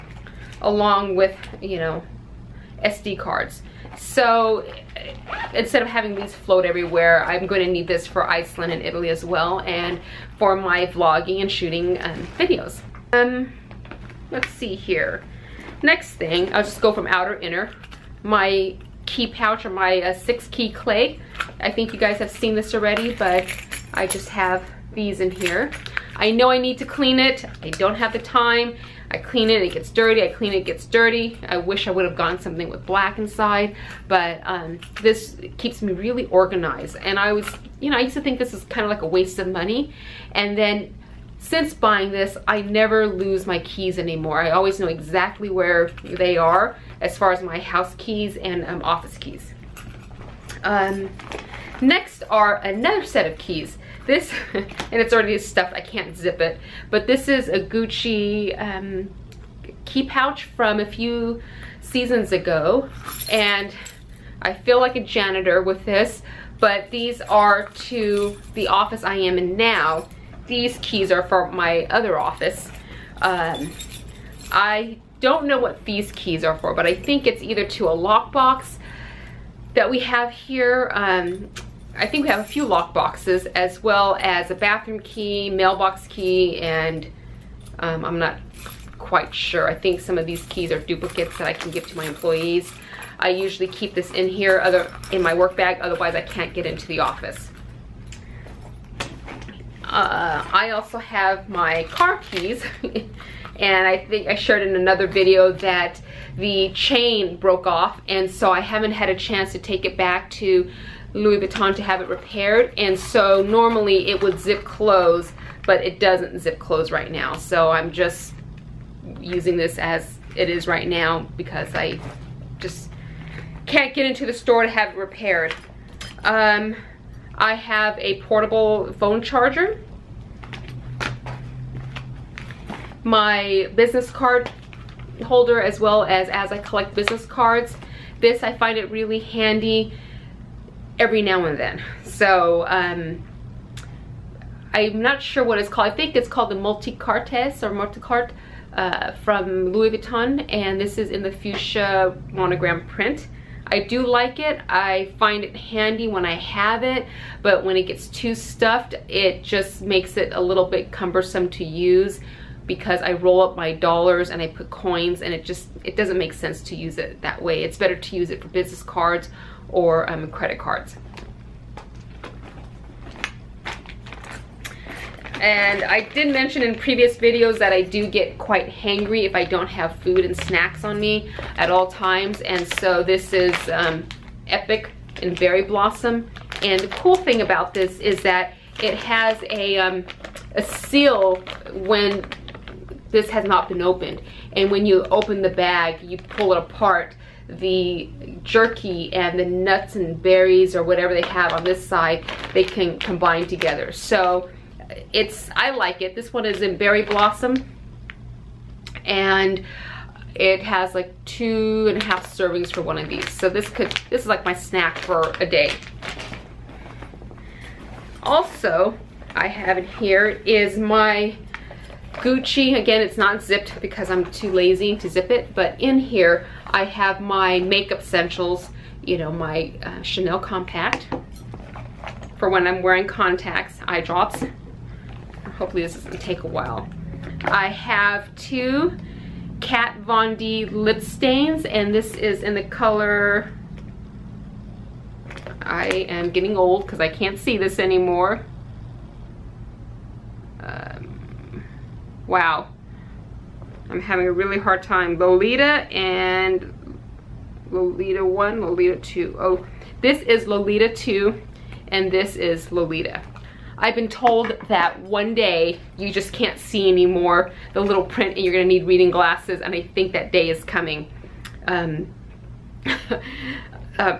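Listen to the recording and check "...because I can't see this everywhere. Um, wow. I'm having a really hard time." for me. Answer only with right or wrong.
wrong.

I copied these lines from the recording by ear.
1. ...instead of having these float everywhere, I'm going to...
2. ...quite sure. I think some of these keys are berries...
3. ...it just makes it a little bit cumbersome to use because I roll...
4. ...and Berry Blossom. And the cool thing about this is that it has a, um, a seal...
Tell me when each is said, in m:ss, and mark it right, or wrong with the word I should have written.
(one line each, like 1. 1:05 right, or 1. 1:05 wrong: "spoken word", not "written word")
1. 0:05 right
2. 1:28 wrong: "duplicates", not "berries"
3. 2:39 right
4. 3:05 right.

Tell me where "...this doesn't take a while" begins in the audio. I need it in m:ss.
3:55.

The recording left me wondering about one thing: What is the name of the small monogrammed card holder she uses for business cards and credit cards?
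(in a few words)
Multicartes.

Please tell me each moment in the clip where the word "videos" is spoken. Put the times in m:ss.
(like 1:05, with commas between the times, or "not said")
0:12, 1:45, 2:57.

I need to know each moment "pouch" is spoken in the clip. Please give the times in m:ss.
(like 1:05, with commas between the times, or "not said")
0:19, 1:00.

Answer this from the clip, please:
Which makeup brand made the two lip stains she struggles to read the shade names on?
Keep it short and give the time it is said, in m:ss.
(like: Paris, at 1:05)
Kat Von D, at 3:59.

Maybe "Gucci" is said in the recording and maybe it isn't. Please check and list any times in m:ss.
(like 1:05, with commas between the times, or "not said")
0:57, 3:42.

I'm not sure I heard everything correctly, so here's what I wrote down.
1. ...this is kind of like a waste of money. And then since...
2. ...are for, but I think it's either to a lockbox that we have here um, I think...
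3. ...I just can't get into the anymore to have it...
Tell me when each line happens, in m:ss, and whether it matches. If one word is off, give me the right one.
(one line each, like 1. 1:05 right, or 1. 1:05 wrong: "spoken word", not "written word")
1. 0:38 right
2. 1:16 right
3. 2:01 wrong: "store", not "anymore".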